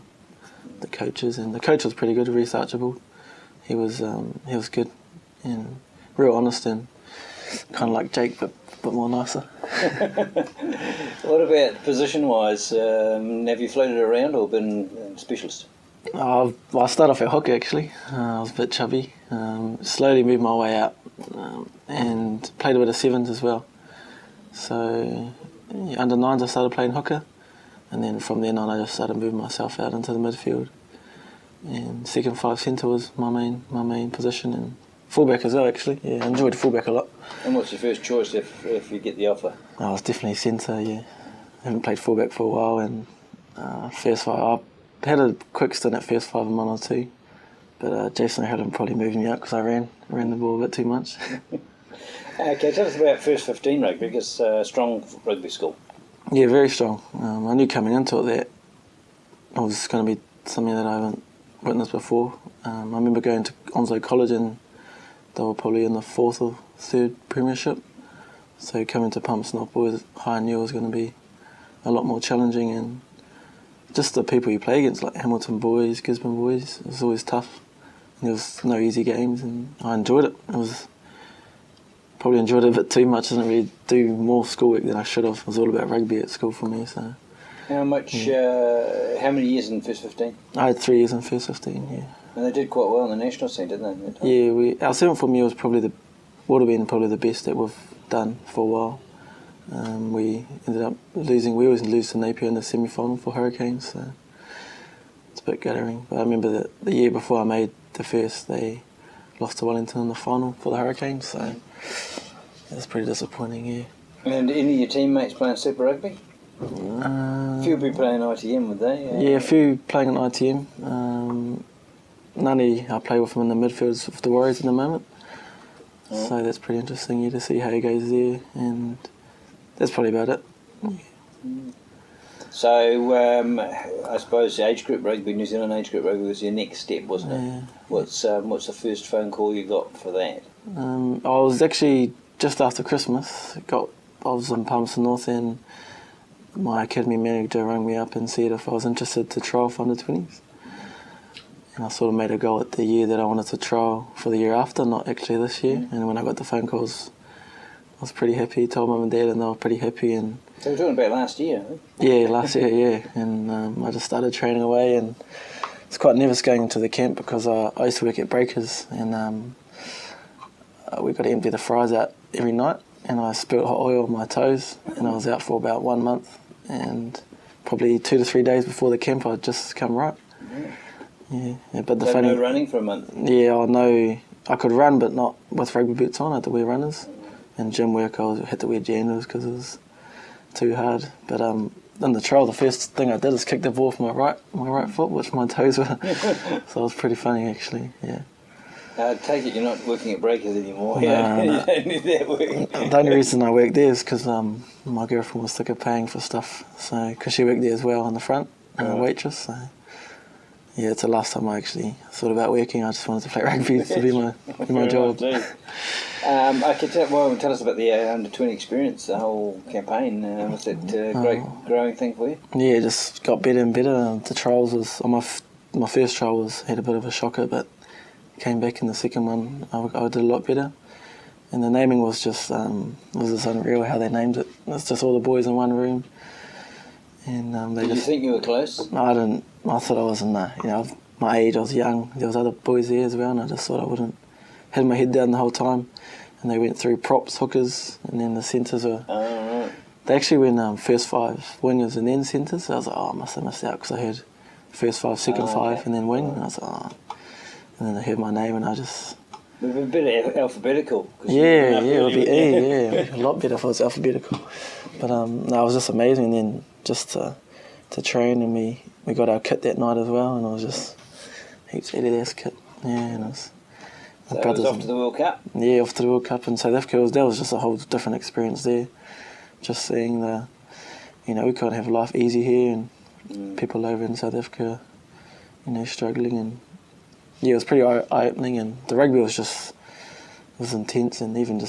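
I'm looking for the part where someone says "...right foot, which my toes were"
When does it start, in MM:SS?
03:14.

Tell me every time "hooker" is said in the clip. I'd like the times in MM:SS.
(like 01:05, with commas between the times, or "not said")
00:26, 04:07.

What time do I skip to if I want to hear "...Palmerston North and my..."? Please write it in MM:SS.
02:24.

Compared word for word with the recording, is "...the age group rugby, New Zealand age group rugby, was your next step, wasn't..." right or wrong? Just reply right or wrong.
right.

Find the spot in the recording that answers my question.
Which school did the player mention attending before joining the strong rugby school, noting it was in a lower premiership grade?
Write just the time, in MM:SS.
01:03.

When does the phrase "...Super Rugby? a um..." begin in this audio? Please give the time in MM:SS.
01:55.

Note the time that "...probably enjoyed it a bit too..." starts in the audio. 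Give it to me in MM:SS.
01:22.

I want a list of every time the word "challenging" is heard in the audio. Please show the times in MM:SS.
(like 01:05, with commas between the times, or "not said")
01:12.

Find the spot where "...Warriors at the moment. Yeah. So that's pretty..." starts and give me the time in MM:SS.
02:04.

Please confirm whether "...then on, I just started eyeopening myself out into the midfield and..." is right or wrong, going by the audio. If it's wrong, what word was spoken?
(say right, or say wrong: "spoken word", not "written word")
wrong: "moving", not "eyeopening".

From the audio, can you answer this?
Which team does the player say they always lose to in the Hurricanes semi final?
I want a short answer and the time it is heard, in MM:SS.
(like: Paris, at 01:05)
Napier, at 01:42.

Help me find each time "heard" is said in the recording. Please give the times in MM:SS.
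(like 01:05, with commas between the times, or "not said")
04:14, 04:18.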